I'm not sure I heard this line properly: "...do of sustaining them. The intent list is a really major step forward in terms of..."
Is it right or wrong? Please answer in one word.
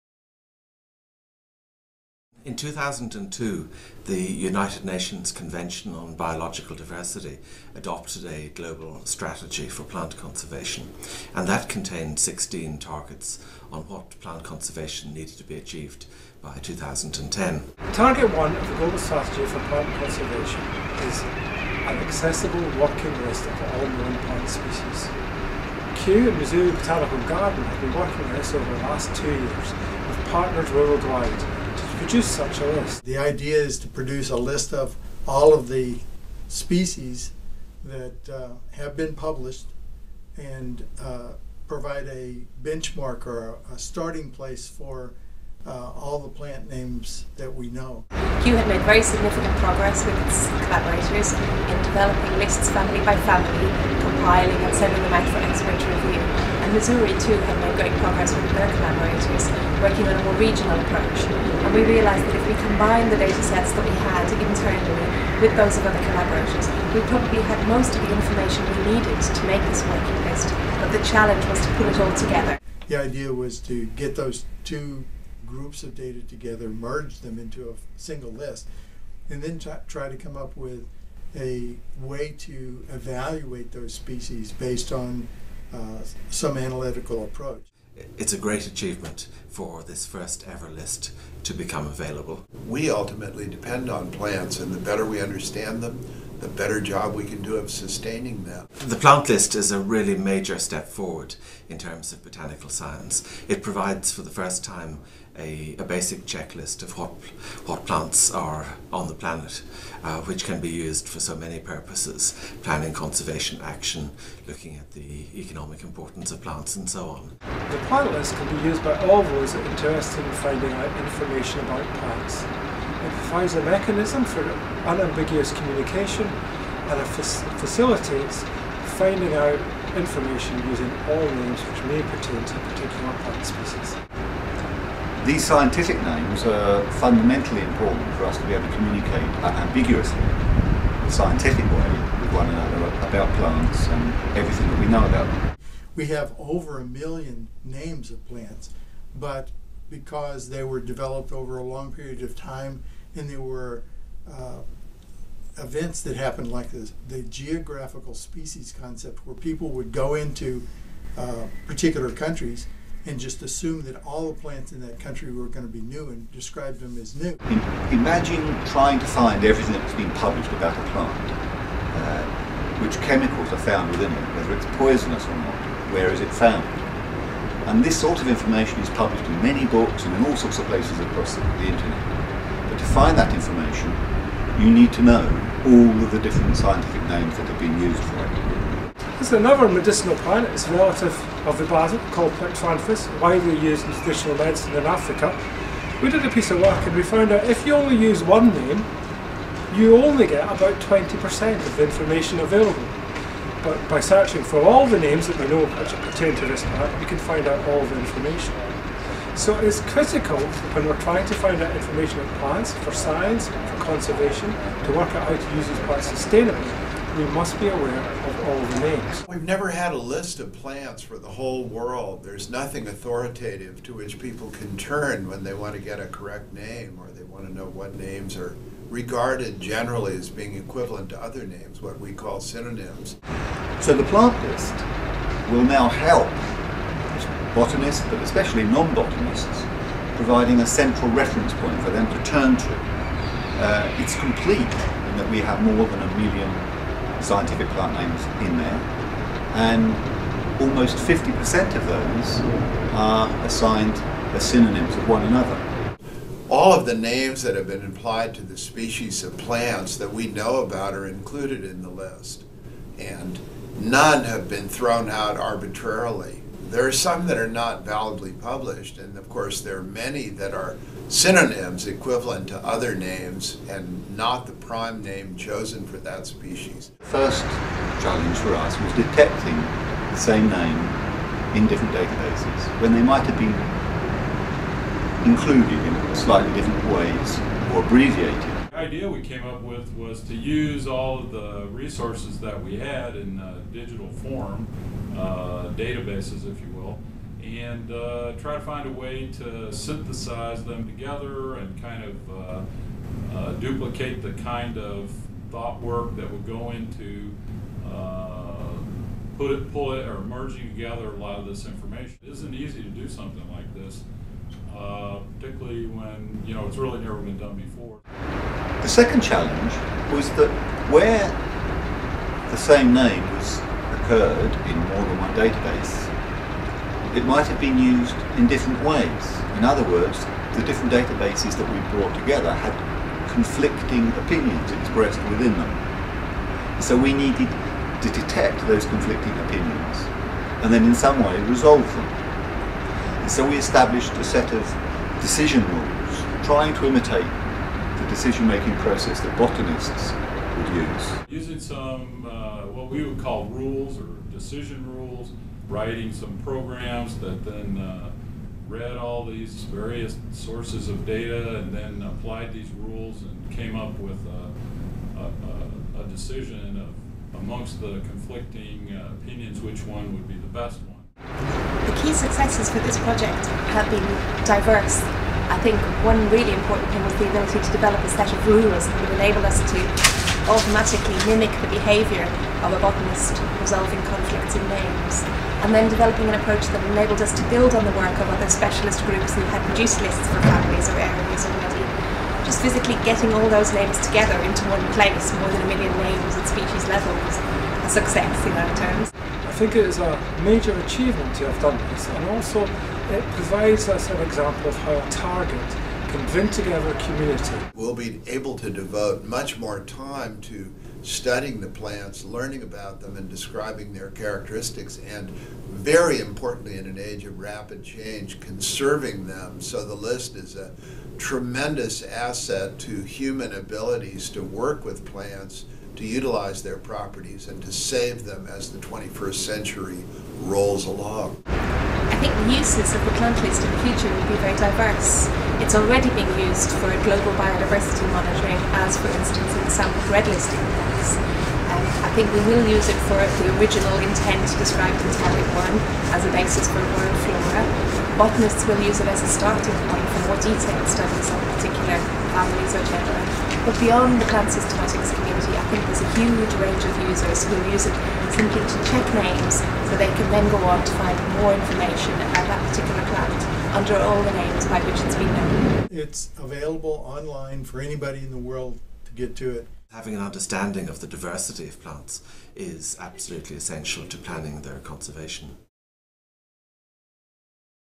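wrong.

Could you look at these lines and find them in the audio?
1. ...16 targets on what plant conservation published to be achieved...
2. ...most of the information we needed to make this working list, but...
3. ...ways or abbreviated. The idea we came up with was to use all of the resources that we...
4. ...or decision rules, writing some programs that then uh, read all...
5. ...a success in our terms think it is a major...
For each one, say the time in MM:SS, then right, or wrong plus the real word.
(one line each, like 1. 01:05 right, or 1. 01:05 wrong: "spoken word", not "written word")
1. 00:12 wrong: "needed", not "published"
2. 01:07 right
3. 04:46 right
4. 05:53 right
5. 06:37 right.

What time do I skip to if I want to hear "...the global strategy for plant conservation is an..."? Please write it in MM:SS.
00:18.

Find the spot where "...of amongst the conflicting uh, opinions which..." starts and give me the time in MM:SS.
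06:06.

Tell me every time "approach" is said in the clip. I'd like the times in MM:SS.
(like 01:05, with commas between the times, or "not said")
01:00, 01:27, 06:26.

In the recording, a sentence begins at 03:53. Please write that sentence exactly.
So the plant list will now help botanists, but especially non-botanists, providing a central reference point for them to turn to.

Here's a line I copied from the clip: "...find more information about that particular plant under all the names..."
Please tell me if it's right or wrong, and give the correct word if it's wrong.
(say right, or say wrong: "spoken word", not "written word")
right.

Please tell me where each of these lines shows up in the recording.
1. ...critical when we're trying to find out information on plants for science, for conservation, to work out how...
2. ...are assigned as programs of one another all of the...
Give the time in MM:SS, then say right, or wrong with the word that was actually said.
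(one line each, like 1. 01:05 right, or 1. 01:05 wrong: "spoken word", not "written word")
1. 03:29 right
2. 04:12 wrong: "synonyms", not "programs".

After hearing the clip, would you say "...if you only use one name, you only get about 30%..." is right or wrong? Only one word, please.
wrong.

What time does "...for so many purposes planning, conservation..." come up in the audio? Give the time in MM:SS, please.
01:51.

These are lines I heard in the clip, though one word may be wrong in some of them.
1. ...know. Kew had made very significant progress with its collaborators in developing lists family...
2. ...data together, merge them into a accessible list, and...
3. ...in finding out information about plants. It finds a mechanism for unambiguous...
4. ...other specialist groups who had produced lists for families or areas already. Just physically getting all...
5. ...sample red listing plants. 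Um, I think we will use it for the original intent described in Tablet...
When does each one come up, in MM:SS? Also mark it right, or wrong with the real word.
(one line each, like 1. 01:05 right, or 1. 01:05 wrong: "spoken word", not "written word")
1. 00:47 right
2. 01:15 wrong: "single", not "accessible"
3. 02:00 right
4. 06:28 right
5. 07:19 right.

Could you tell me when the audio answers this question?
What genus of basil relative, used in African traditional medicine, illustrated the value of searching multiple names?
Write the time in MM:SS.
03:12.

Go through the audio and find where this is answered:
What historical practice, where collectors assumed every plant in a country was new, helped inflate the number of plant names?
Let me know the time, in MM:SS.
02:37.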